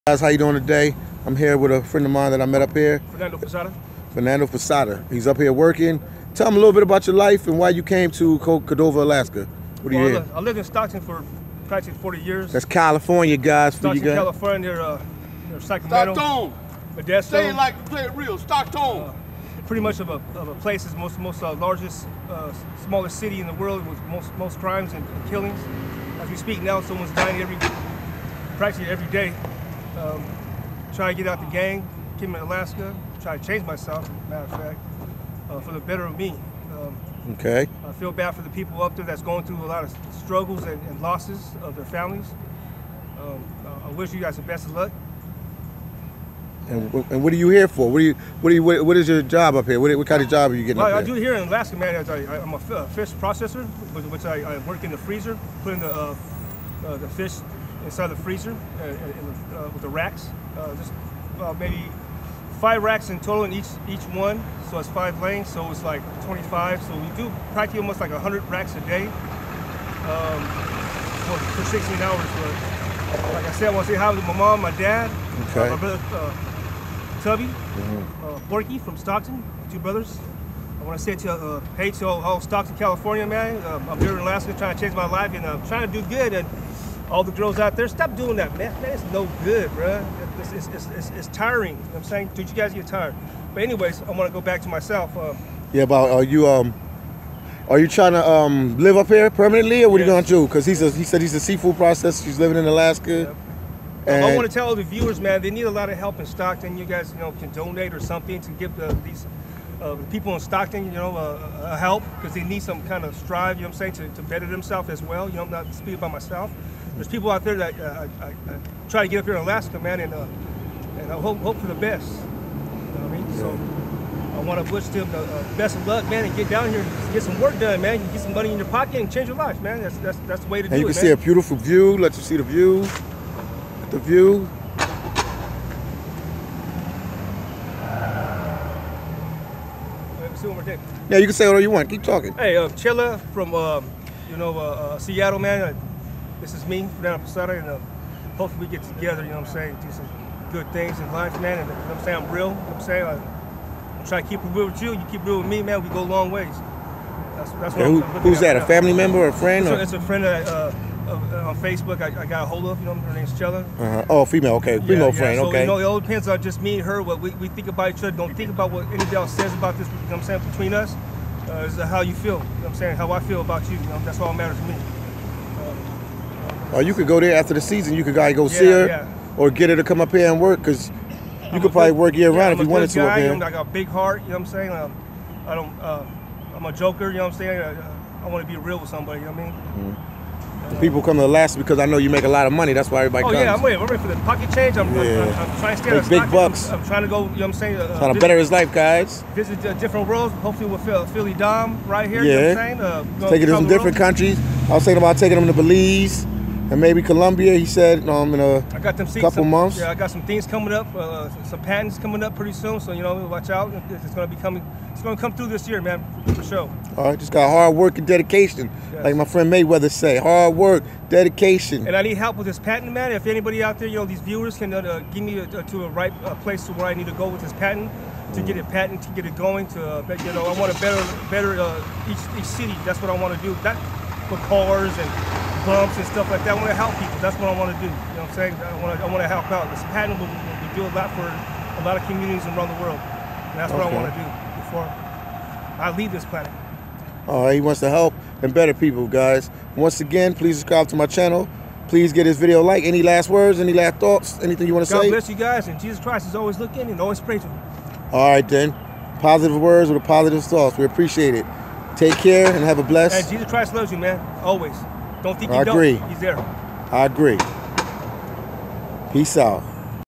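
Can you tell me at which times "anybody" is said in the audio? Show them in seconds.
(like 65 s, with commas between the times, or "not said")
168 s, 223 s.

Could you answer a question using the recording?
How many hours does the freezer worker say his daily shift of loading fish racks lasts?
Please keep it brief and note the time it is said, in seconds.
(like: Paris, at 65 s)
16, at 71 s.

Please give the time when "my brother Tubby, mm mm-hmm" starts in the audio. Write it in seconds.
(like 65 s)
75 s.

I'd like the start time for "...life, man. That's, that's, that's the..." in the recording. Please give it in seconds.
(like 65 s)
129 s.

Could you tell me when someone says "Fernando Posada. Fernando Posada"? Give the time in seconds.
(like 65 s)
3 s.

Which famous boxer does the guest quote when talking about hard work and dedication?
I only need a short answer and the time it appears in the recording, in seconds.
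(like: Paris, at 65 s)
Mayweather, at 219 s.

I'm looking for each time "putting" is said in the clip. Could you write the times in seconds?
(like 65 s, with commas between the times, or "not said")
55 s.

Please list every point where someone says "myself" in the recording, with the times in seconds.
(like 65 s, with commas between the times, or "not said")
33 s, 94 s, 116 s.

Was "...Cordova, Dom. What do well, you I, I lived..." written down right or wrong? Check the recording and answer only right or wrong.
wrong.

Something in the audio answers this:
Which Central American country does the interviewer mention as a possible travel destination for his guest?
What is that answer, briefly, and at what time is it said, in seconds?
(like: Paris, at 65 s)
Belize, at 205 s.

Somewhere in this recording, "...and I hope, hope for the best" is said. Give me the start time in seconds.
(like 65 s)
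120 s.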